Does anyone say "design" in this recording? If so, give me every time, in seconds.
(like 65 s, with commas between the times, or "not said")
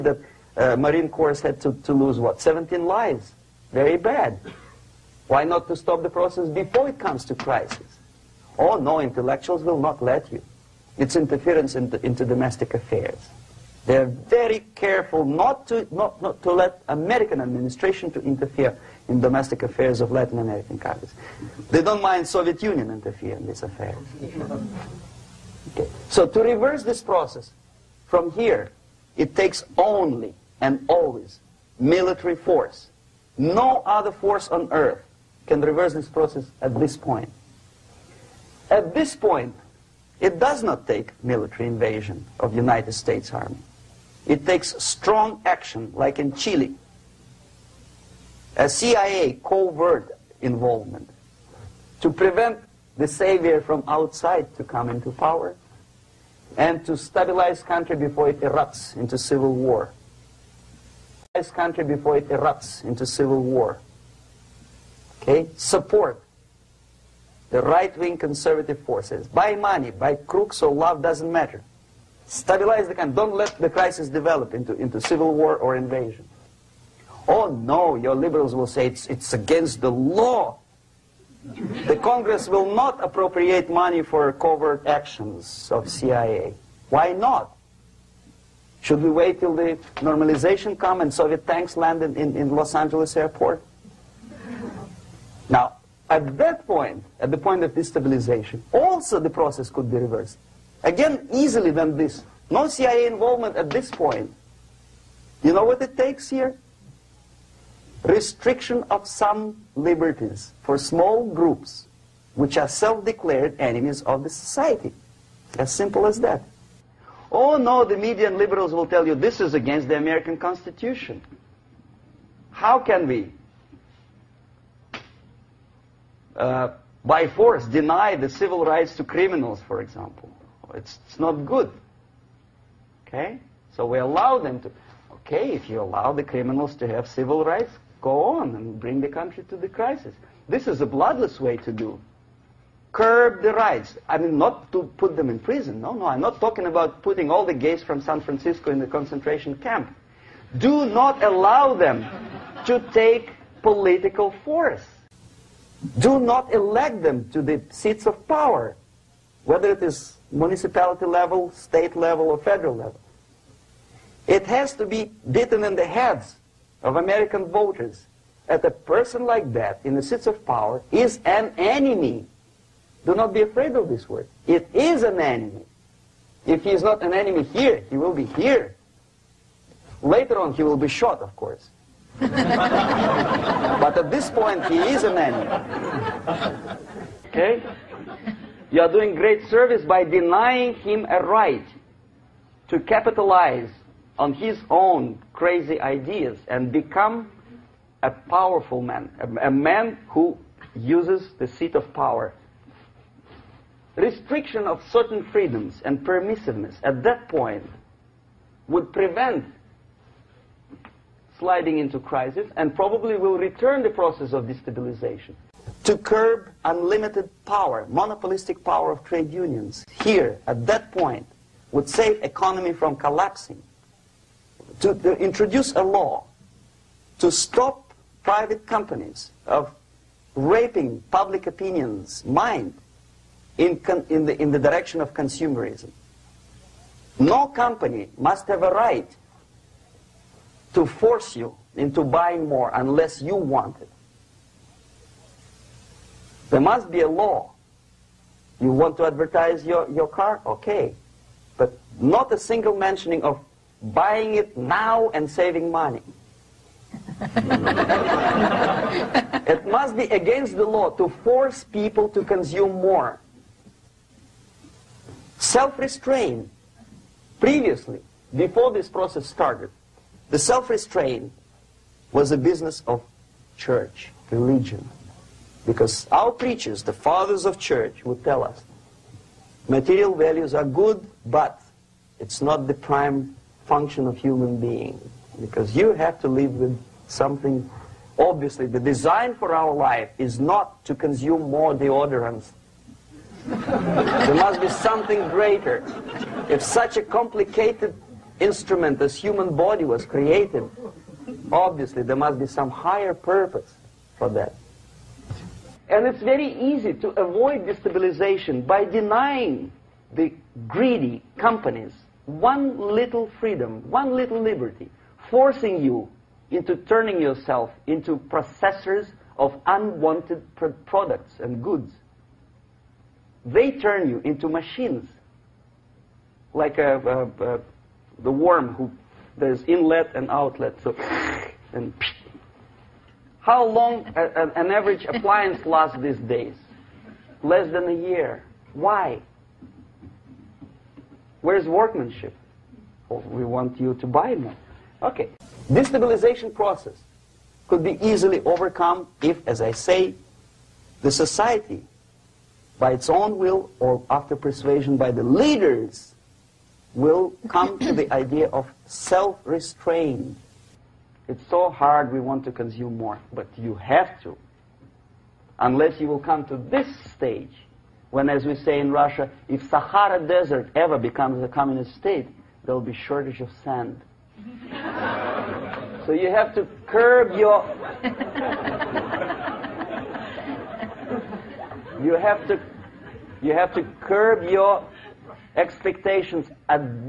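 288 s.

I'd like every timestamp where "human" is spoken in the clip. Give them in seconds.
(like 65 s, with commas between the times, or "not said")
284 s, 299 s.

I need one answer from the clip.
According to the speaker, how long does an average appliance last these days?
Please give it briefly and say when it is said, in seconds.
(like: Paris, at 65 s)
Less than a year, at 337 s.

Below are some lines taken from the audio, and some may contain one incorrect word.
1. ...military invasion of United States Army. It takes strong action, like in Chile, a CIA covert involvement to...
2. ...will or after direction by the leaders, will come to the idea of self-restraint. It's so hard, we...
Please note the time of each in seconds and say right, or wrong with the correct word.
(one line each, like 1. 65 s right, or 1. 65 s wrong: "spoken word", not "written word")
1. 41 s right
2. 353 s wrong: "persuasion", not "direction".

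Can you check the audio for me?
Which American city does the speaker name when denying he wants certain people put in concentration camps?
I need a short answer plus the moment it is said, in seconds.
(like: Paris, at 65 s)
San Francisco, at 148 s.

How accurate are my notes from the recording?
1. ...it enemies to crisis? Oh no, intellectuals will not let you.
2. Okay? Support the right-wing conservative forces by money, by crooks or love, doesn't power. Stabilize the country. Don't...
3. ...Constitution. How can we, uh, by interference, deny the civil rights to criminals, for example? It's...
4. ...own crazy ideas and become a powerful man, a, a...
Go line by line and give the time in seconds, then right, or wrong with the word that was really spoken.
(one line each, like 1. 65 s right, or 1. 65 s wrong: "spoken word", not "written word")
1. 6 s wrong: "comes", not "enemies"
2. 65 s wrong: "matter", not "power"
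3. 120 s wrong: "force", not "interference"
4. 194 s right.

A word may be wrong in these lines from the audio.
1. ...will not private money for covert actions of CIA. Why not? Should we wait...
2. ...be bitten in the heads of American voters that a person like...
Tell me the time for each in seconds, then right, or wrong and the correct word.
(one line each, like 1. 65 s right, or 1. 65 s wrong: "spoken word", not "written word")
1. 82 s wrong: "appropriate", not "private"
2. 164 s right.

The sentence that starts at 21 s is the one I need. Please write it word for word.
They don't mind Soviet Union interfere in this affair.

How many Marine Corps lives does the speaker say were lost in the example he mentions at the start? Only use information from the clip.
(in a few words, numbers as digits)
17.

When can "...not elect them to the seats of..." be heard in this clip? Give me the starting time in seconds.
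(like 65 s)
156 s.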